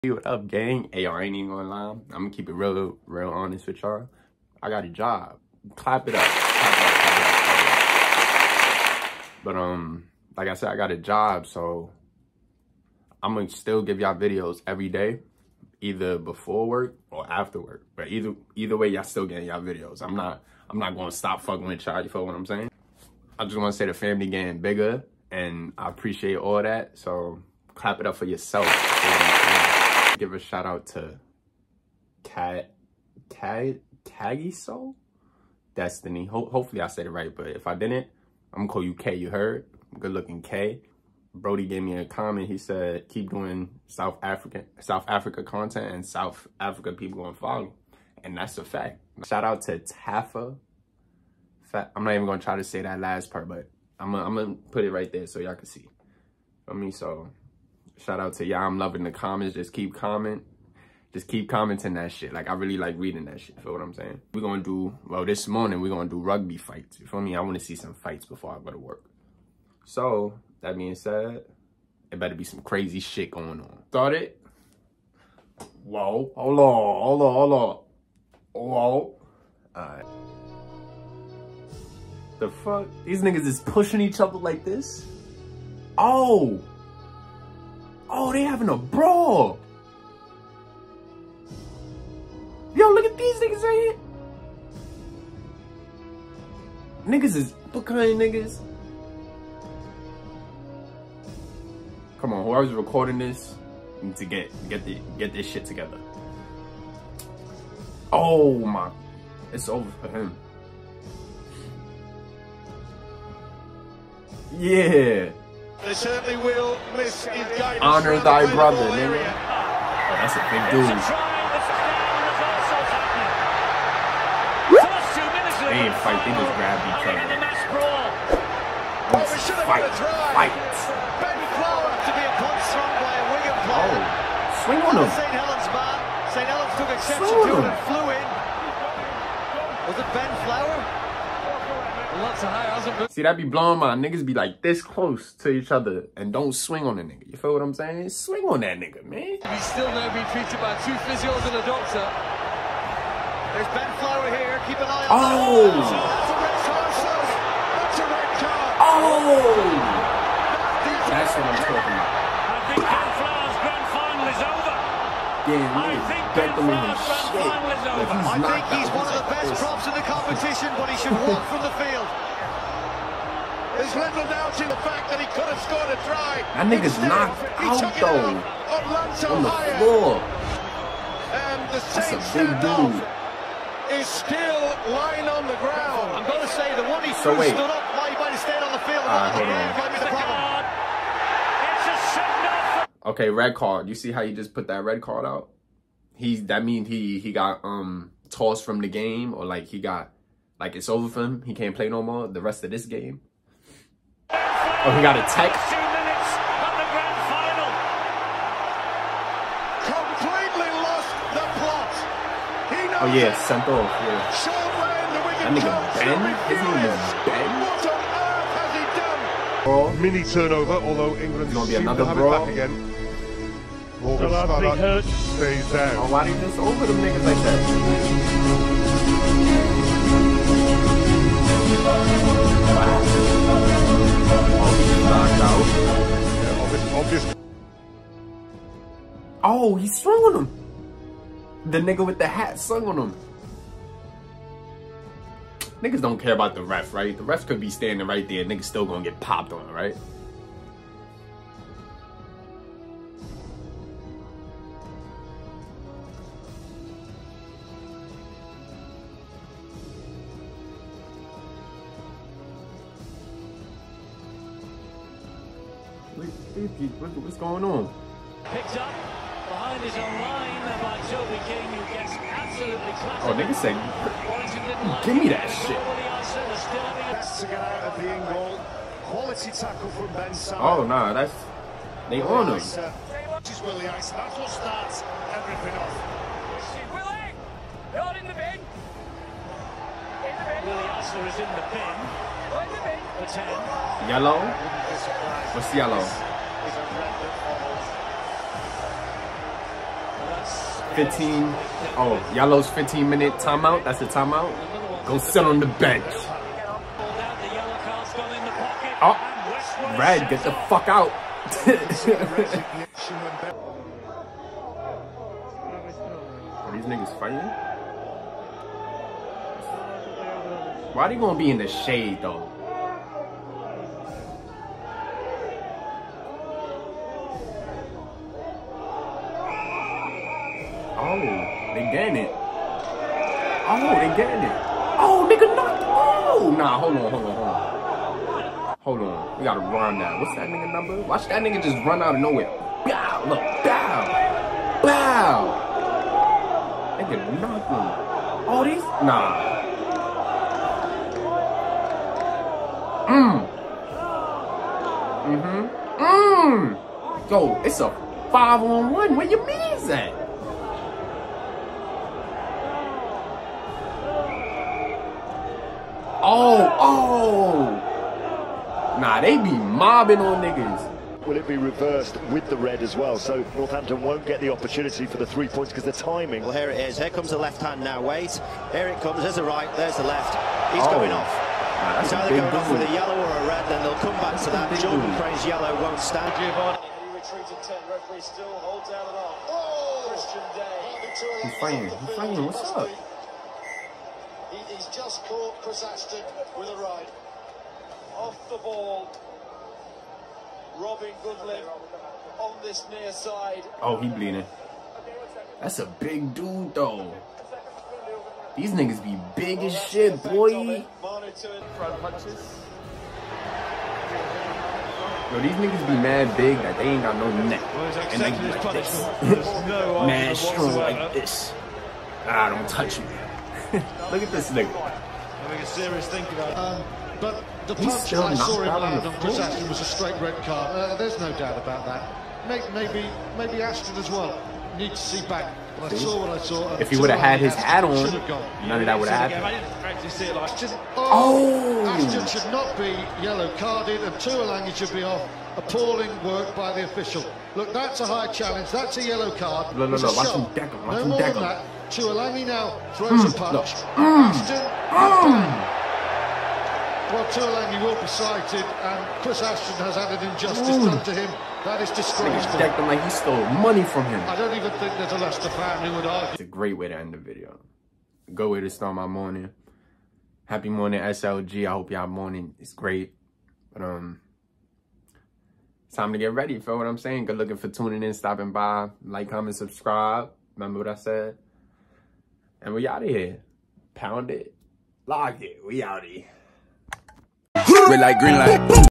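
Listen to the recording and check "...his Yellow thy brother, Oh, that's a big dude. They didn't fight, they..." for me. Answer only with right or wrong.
wrong.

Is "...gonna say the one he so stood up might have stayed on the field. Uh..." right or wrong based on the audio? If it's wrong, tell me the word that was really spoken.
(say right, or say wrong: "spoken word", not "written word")
right.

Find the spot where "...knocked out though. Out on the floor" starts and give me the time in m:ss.
2:57.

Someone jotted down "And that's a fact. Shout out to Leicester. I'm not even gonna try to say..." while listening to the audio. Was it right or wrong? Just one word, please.
wrong.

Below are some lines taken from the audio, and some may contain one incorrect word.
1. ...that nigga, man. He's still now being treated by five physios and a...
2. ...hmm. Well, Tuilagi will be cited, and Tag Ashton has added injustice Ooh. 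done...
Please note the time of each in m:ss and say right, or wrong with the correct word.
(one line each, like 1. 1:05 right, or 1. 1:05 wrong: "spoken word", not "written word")
1. 2:28 wrong: "two", not "five"
2. 7:34 wrong: "Chris", not "Tag".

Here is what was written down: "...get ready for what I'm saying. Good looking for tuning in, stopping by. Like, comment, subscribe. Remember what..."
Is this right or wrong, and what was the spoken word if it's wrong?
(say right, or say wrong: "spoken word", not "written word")
right.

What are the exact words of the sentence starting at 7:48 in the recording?
Go way to start my morning.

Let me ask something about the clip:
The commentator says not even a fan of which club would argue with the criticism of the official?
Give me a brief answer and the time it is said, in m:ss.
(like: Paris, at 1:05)
Leicester, at 7:45.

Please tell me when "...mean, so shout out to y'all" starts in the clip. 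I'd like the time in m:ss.
0:56.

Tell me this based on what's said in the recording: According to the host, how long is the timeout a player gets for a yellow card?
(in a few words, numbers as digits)
15 minutes.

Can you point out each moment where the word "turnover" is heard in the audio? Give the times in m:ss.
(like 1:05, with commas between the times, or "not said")
3:40.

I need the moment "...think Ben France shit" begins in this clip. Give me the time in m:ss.
2:46.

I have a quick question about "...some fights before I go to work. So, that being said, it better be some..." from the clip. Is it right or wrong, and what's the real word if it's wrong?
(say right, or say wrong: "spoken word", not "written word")
right.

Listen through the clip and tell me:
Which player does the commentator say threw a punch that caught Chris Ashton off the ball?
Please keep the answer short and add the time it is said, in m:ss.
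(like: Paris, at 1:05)
Christian Day, at 6:30.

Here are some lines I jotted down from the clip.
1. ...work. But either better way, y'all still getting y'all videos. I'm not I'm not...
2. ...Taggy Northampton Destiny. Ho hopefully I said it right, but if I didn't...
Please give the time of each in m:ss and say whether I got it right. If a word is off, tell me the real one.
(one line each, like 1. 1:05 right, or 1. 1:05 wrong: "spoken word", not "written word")
1. 0:17 wrong: "either", not "better"
2. 0:34 wrong: "Soul", not "Northampton".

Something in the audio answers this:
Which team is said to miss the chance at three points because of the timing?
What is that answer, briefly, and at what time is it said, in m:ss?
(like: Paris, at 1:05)
Northampton, at 6:13.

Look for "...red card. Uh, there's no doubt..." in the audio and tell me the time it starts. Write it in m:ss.
7:10.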